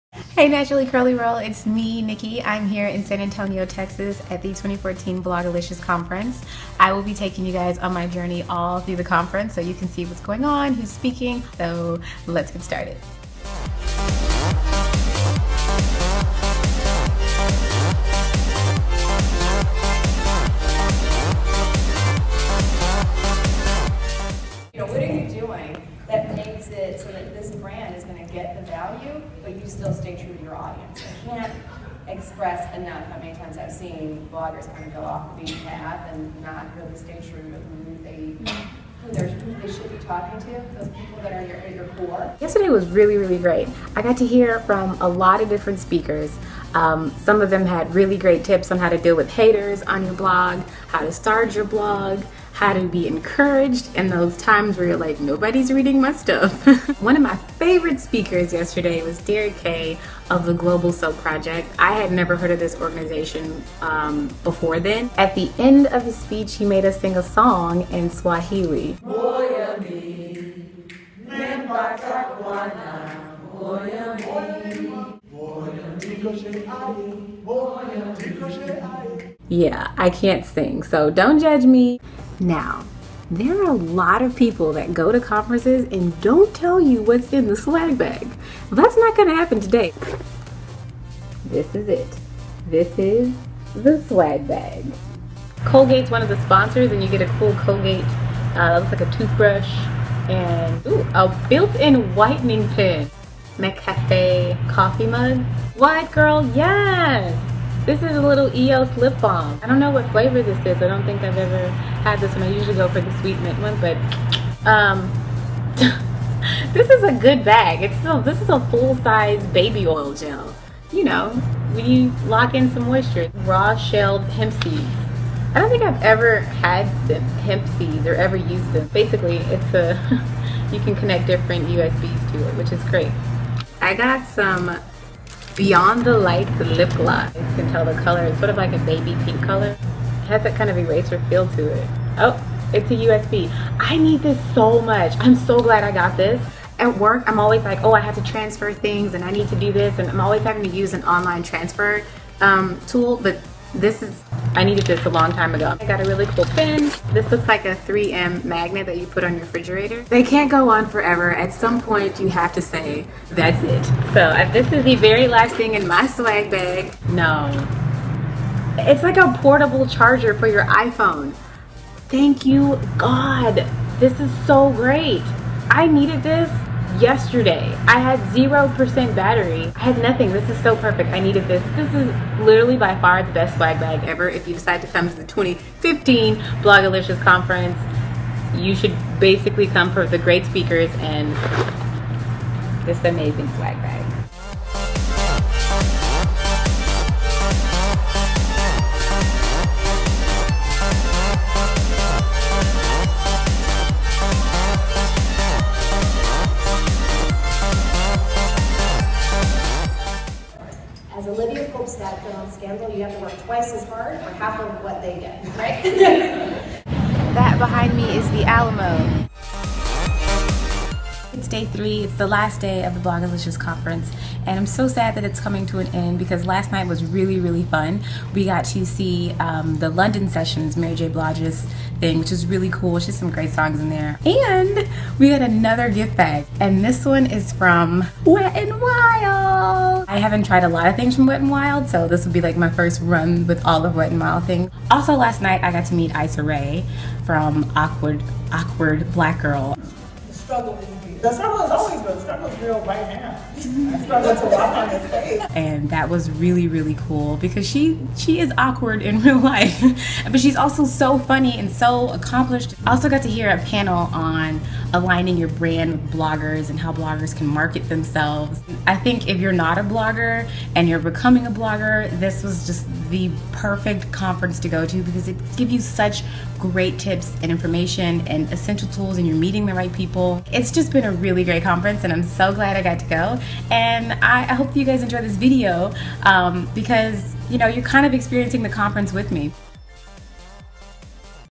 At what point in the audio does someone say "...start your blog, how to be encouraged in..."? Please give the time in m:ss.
0:51.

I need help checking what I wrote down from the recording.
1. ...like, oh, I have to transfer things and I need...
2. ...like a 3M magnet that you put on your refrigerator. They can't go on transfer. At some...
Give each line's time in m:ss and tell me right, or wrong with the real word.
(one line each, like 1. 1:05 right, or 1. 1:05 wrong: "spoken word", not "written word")
1. 2:27 right
2. 2:37 wrong: "forever", not "transfer".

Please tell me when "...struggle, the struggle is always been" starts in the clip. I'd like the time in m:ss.
4:10.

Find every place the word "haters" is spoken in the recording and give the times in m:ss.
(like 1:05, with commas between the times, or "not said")
0:49.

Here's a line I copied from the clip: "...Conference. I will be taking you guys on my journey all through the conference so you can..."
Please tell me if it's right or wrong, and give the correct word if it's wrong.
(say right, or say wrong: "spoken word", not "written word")
right.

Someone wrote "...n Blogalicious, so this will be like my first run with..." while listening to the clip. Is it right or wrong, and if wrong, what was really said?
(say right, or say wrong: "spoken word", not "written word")
wrong: "Wild", not "Blogalicious".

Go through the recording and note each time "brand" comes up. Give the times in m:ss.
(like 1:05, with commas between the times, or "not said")
0:27, 4:25.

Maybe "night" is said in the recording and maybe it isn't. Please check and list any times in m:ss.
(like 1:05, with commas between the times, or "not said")
3:46, 4:05.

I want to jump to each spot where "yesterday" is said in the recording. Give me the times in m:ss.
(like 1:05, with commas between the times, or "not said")
0:42, 0:58, 2:56.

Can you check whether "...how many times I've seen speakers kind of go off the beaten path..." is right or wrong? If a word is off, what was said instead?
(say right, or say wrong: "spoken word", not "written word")
wrong: "bloggers", not "speakers".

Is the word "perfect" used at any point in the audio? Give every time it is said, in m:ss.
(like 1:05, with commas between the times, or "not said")
3:00, 4:33.